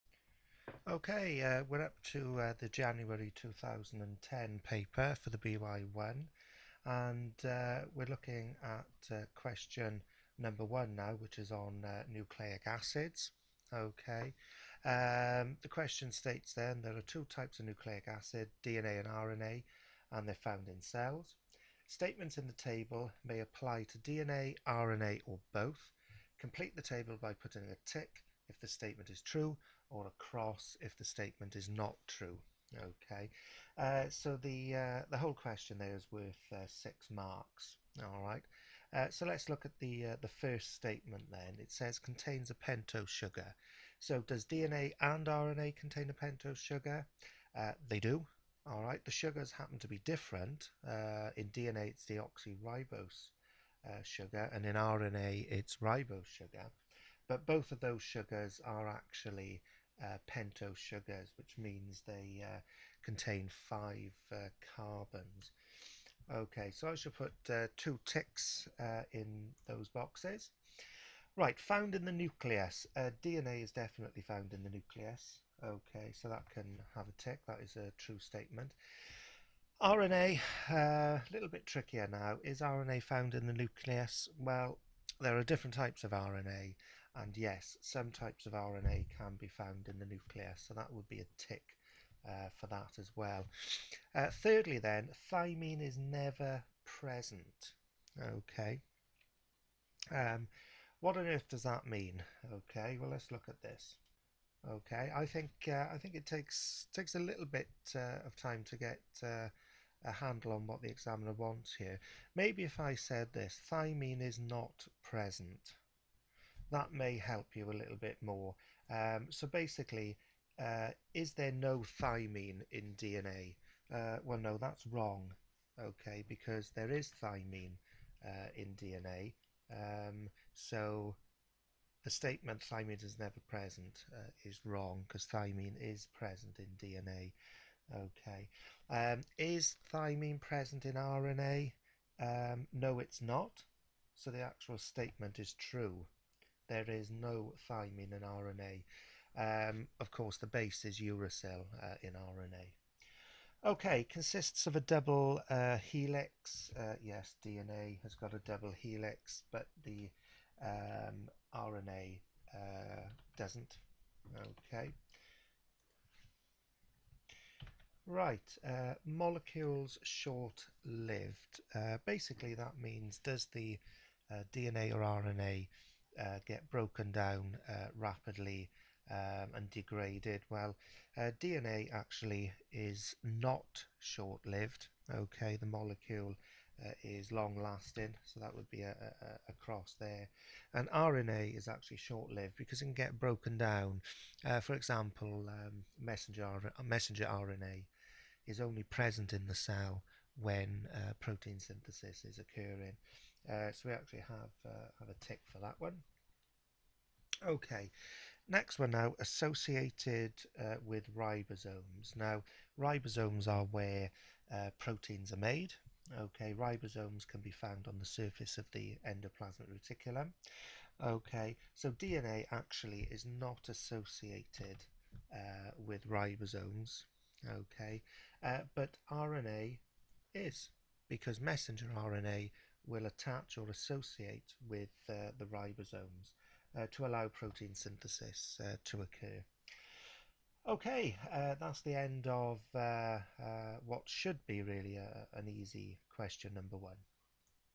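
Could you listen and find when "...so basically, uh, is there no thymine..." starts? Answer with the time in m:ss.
1:59.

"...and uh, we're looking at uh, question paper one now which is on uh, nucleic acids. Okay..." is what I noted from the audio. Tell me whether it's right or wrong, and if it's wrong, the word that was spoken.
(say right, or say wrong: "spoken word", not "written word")
wrong: "number", not "paper".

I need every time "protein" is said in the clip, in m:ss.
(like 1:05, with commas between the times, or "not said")
3:21, 3:34, 3:57.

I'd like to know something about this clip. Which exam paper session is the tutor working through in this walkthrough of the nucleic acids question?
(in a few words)
January 2010.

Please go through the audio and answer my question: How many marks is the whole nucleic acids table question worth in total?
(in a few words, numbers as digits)
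6.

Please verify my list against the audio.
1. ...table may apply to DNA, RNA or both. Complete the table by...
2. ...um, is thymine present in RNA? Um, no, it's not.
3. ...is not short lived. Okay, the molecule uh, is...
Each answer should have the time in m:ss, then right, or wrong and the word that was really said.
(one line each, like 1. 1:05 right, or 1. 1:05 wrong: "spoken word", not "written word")
1. 0:22 right
2. 2:18 right
3. 3:02 right.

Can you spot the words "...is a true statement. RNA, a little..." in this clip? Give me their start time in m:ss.
1:17.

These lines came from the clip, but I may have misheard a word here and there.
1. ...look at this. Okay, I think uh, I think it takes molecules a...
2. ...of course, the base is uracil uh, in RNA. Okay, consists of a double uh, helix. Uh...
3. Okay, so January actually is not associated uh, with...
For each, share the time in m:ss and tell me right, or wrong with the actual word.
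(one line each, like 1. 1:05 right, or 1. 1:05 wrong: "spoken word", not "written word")
1. 1:43 wrong: "takes", not "molecules"
2. 2:29 right
3. 3:41 wrong: "DNA", not "January".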